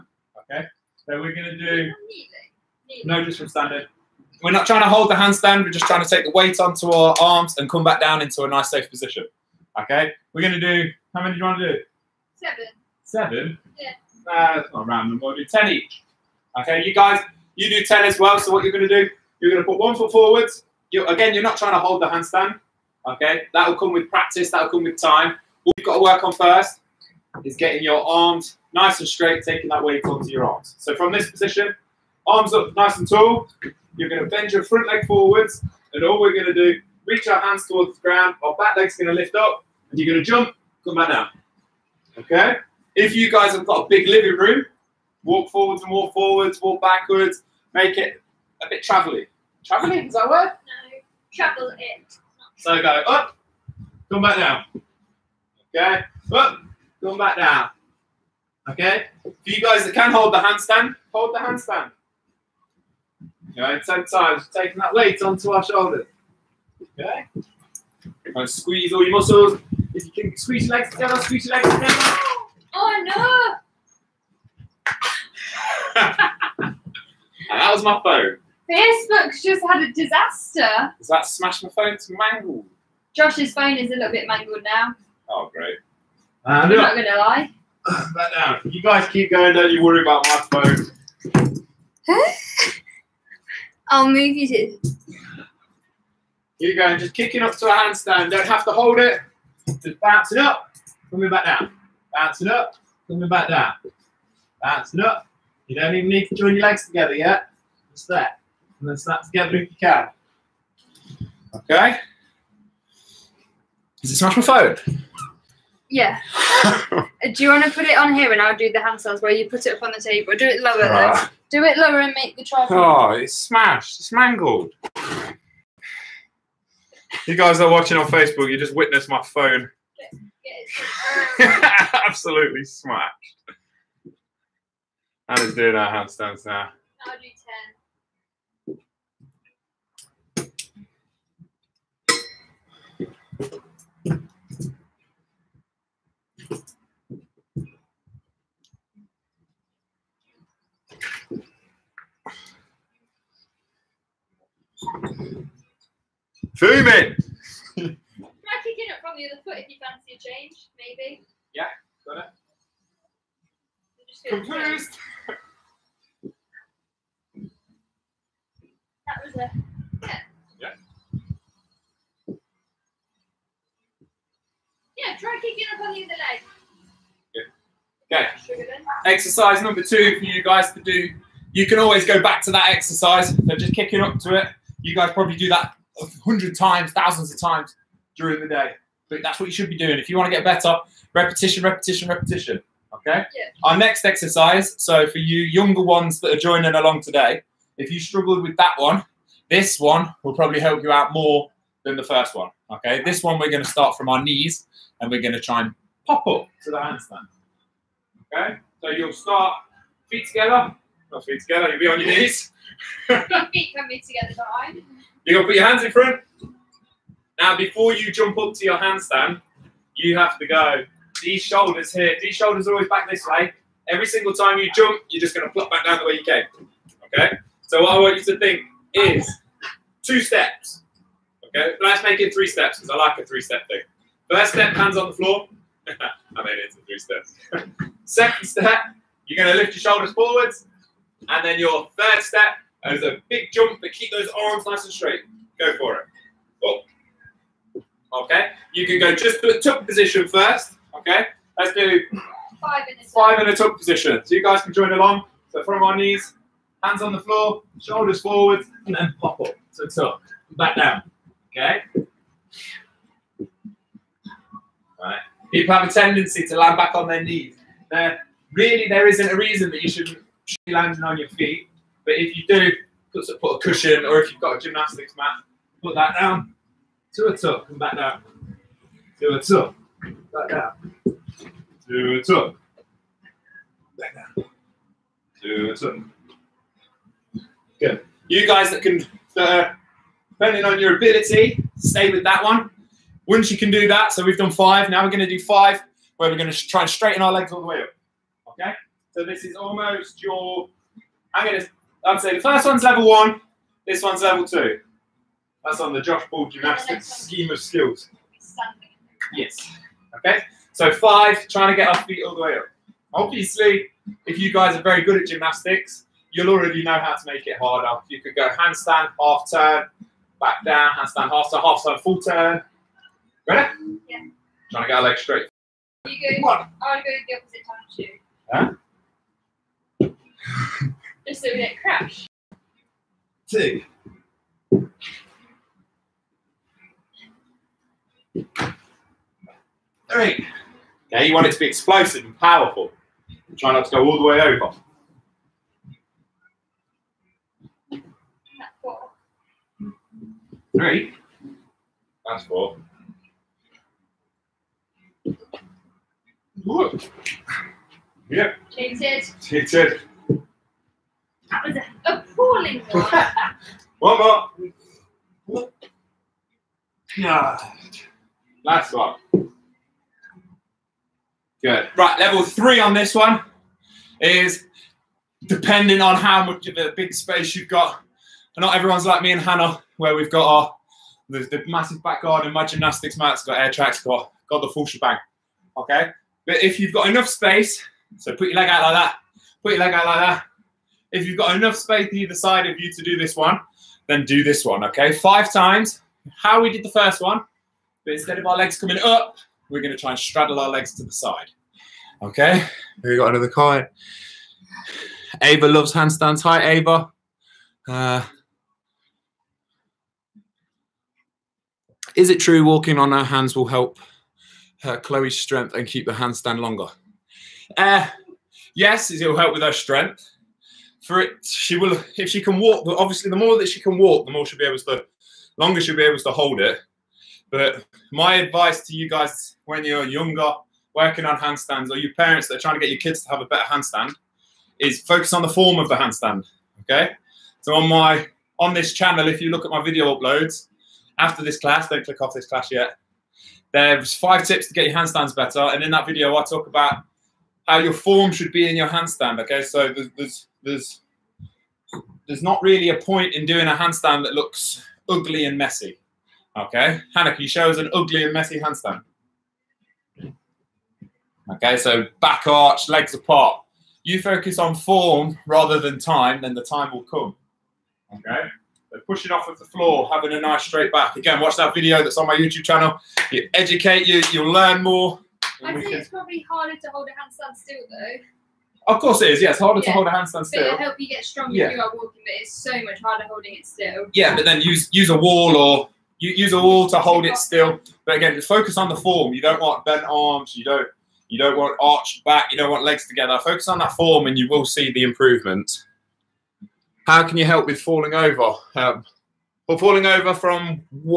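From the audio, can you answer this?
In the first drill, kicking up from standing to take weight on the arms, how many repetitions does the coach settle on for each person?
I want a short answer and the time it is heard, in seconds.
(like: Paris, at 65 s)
10, at 15 s.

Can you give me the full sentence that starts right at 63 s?
Okay, 10 times, taking that weight onto our shoulders.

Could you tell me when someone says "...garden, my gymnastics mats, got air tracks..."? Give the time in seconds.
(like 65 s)
382 s.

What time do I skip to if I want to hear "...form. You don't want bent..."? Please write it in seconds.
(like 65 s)
488 s.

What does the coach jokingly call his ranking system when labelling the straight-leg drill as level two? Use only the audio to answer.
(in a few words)
Josh Bull gymnastics scheme.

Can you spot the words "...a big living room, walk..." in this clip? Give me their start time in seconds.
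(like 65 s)
43 s.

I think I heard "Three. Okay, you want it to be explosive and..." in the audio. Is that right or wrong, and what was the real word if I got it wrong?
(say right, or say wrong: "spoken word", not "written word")
right.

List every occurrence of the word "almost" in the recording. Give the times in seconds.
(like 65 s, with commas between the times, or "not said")
299 s.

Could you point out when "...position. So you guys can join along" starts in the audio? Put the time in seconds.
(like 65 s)
253 s.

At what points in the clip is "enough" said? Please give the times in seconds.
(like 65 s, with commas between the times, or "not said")
104 s, 387 s, 391 s.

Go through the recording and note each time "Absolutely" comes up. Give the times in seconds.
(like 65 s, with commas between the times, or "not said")
132 s.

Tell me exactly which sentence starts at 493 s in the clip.
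Focus on that form and you will see the improvement.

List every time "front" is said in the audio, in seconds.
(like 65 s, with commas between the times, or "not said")
34 s, 215 s.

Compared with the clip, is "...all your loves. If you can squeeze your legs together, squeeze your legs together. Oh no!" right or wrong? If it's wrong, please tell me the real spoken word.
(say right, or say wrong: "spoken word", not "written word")
wrong: "muscles", not "loves".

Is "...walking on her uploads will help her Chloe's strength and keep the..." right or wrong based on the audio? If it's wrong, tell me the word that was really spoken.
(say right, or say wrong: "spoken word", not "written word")
wrong: "hands", not "uploads".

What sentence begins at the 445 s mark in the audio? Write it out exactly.
And in that video, I talk about how your form should be in your handstand.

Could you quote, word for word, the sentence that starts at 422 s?
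Obviously, the more that she can walk, the more she'll be able to, longer she'll be able to hold it.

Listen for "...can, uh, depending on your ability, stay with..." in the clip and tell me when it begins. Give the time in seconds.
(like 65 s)
288 s.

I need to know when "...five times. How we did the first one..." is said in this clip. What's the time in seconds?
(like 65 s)
395 s.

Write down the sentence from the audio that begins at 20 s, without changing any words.
You, again, you're not trying to hold the handstand.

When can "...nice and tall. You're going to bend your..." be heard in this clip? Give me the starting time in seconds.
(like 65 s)
32 s.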